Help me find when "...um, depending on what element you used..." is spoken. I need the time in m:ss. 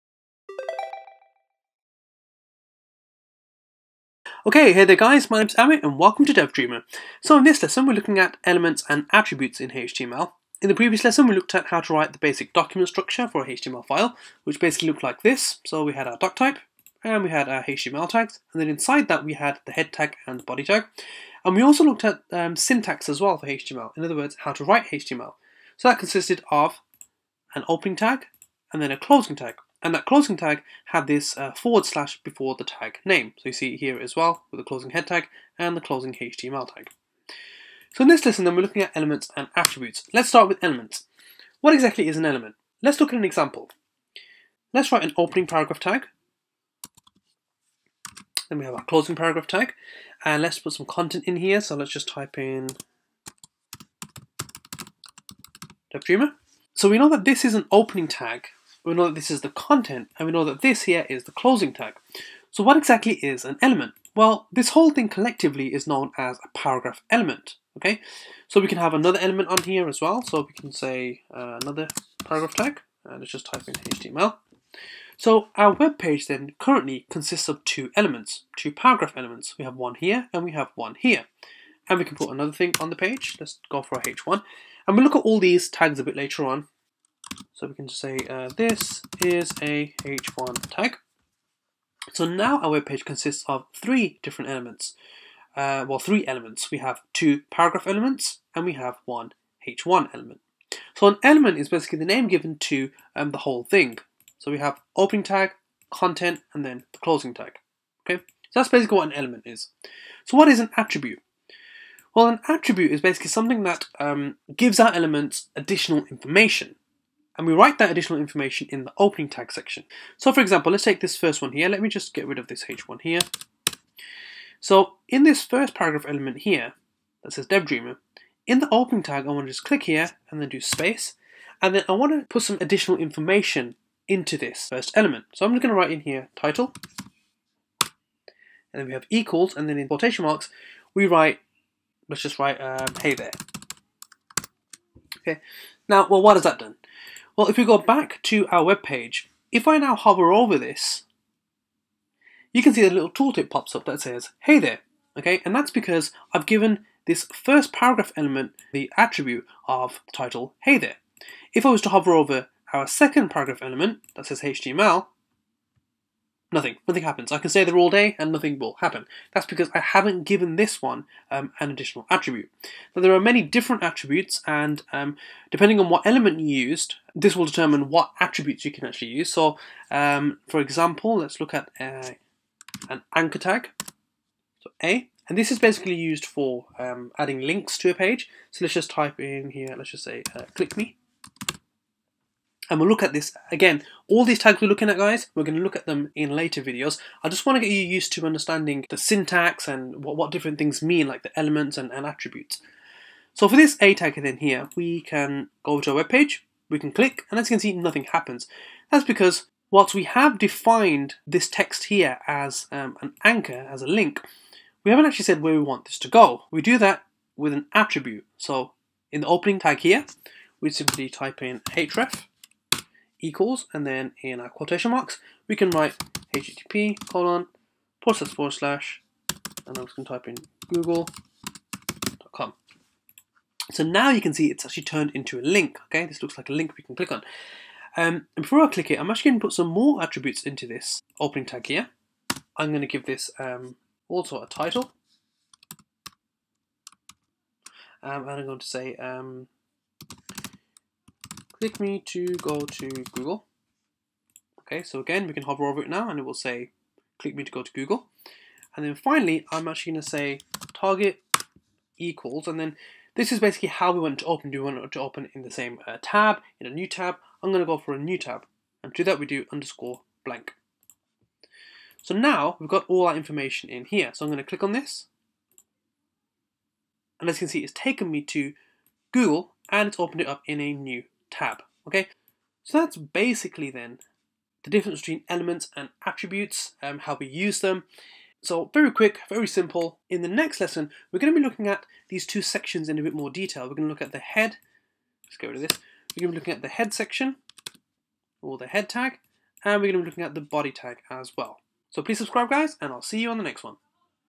2:54.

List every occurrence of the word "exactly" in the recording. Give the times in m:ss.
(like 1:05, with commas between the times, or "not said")
0:41, 1:02.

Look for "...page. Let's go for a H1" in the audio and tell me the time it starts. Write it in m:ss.
1:22.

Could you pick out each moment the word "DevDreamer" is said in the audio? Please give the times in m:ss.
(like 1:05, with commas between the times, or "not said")
0:06, 0:55, 2:07.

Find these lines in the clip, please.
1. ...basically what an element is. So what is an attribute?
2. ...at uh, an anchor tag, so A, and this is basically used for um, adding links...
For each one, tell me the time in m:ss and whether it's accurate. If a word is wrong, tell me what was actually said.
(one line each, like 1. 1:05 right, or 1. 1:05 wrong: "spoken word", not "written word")
1. 1:48 right
2. 3:01 right.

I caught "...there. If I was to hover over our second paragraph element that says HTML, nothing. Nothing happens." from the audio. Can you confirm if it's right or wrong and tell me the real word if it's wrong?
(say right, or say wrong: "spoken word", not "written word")
right.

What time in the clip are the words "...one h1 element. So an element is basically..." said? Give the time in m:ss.
1:39.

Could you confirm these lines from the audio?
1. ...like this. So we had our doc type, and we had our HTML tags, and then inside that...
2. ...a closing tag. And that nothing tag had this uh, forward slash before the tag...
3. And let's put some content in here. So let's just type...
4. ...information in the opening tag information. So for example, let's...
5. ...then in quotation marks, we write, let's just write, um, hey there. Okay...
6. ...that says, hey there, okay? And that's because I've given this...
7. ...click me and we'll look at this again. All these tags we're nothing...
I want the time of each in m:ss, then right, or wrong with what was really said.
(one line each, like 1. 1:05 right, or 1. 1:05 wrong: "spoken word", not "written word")
1. 0:15 right
2. 0:28 wrong: "closing", not "nothing"
3. 0:50 right
4. 1:58 wrong: "section", not "information"
5. 2:19 right
6. 2:33 right
7. 3:10 wrong: "looking", not "nothing".